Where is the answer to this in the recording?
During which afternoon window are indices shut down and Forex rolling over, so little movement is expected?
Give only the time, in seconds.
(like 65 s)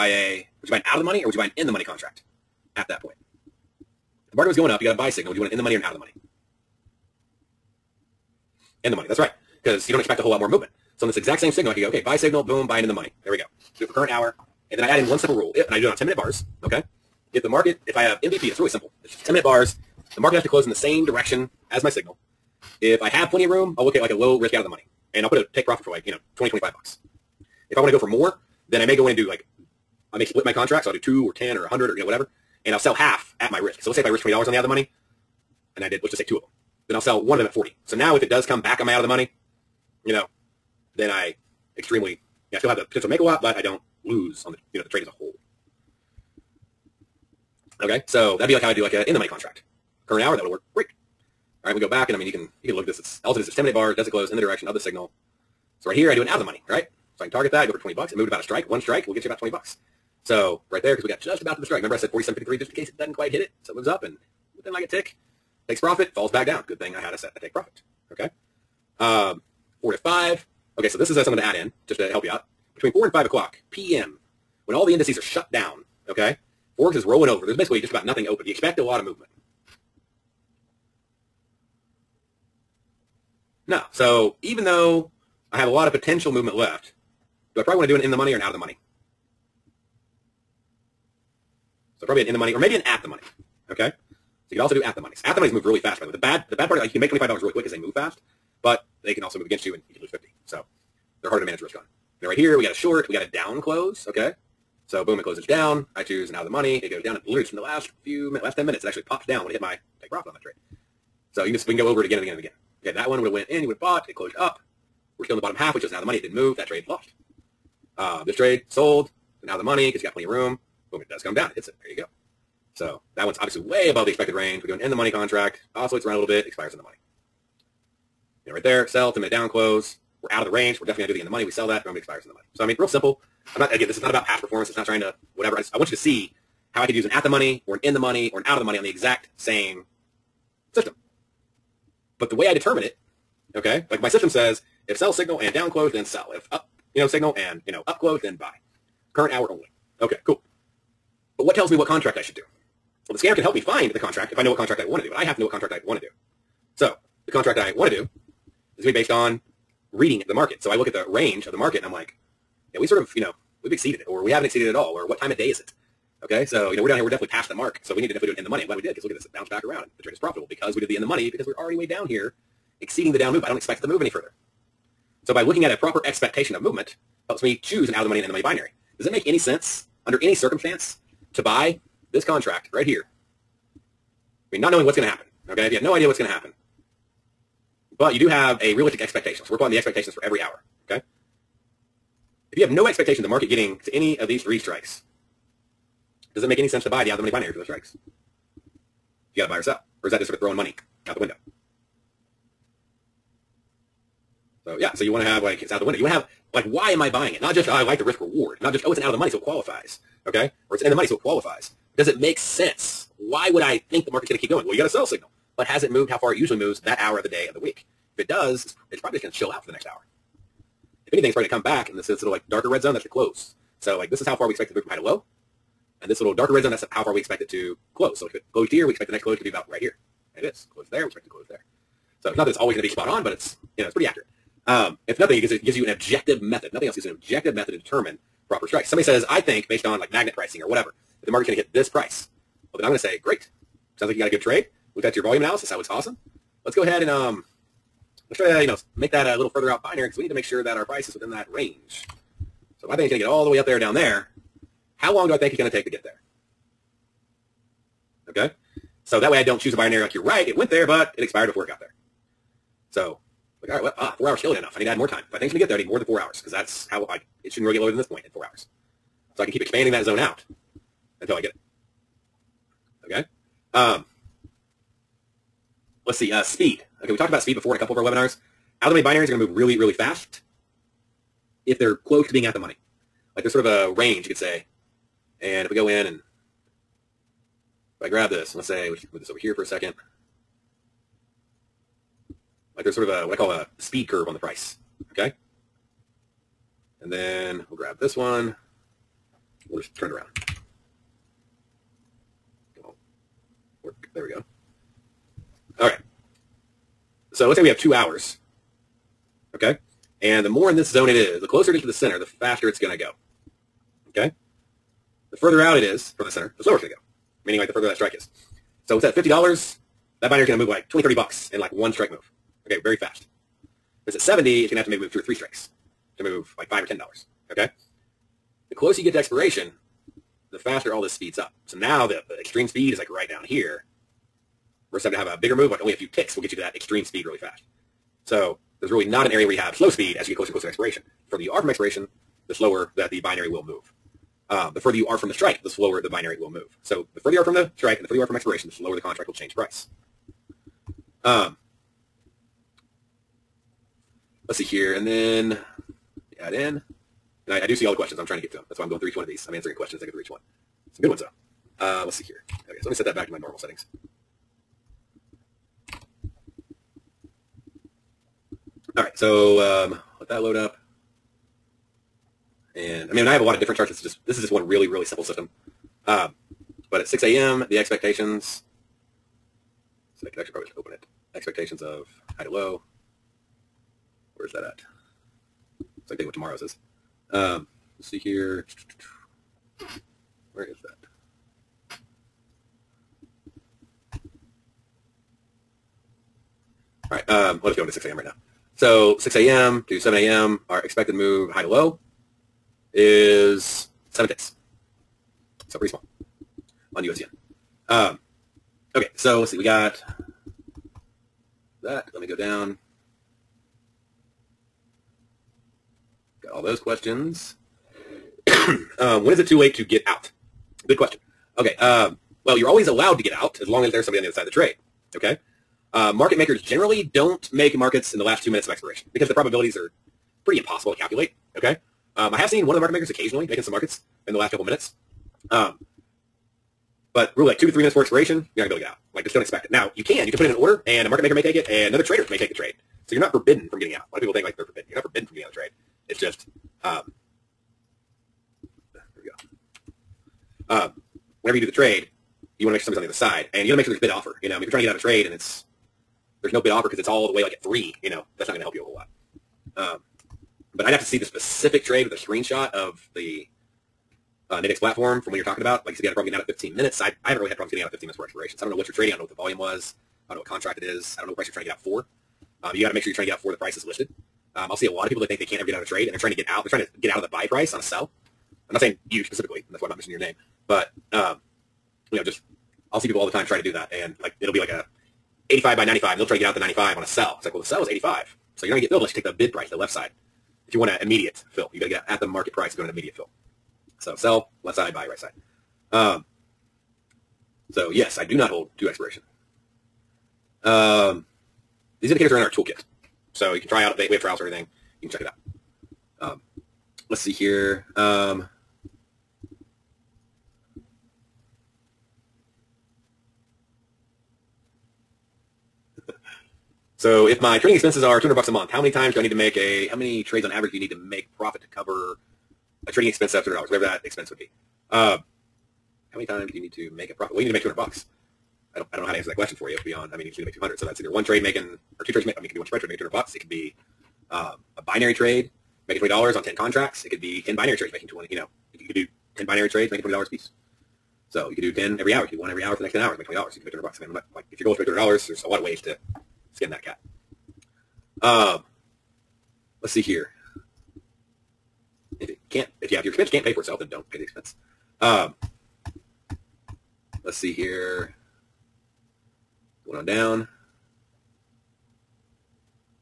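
72 s.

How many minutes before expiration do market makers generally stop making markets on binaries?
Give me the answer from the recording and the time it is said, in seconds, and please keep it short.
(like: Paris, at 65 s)
2 minutes, at 428 s.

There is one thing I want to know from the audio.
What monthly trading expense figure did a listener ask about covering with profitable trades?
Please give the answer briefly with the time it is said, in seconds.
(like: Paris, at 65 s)
$200, at 518 s.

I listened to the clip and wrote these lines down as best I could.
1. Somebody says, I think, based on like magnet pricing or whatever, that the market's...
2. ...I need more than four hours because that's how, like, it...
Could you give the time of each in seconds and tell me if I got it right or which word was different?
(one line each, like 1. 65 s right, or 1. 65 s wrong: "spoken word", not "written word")
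1. 238 s right
2. 265 s right.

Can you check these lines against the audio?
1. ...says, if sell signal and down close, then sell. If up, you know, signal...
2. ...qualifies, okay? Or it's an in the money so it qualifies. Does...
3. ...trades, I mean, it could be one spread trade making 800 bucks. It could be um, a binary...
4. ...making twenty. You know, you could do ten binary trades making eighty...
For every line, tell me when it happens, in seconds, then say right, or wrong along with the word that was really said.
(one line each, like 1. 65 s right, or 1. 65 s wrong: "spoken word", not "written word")
1. 144 s right
2. 209 s right
3. 532 s wrong: "200", not "800"
4. 537 s wrong: "twenty", not "eighty".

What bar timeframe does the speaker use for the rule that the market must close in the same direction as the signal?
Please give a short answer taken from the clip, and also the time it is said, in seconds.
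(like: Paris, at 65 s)
10-minute bars, at 15 s.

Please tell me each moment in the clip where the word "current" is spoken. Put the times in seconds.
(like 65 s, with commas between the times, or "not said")
13 s, 50 s, 149 s.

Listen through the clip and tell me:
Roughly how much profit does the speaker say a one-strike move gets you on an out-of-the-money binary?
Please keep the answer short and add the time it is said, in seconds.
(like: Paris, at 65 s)
$20, at 59 s.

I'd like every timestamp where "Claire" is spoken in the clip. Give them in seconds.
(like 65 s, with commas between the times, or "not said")
not said.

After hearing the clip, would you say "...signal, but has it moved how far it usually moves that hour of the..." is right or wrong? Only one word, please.
right.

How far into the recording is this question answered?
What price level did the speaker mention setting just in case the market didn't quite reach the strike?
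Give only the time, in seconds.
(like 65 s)
62 s.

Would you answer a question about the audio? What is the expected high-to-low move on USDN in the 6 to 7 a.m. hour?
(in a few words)
7 ticks.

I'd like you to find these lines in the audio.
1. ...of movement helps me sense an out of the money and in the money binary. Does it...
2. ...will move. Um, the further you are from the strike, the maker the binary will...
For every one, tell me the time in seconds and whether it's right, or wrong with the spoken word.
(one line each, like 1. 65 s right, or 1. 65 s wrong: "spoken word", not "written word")
1. 176 s wrong: "choose", not "sense"
2. 343 s wrong: "slower", not "maker".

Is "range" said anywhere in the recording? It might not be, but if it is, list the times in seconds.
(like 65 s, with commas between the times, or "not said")
124 s, 130 s, 161 s, 251 s, 283 s.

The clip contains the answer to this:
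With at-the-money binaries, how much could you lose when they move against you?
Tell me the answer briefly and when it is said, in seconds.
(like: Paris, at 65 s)
$50, at 100 s.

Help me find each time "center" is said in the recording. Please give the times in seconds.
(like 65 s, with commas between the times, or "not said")
311 s, 316 s.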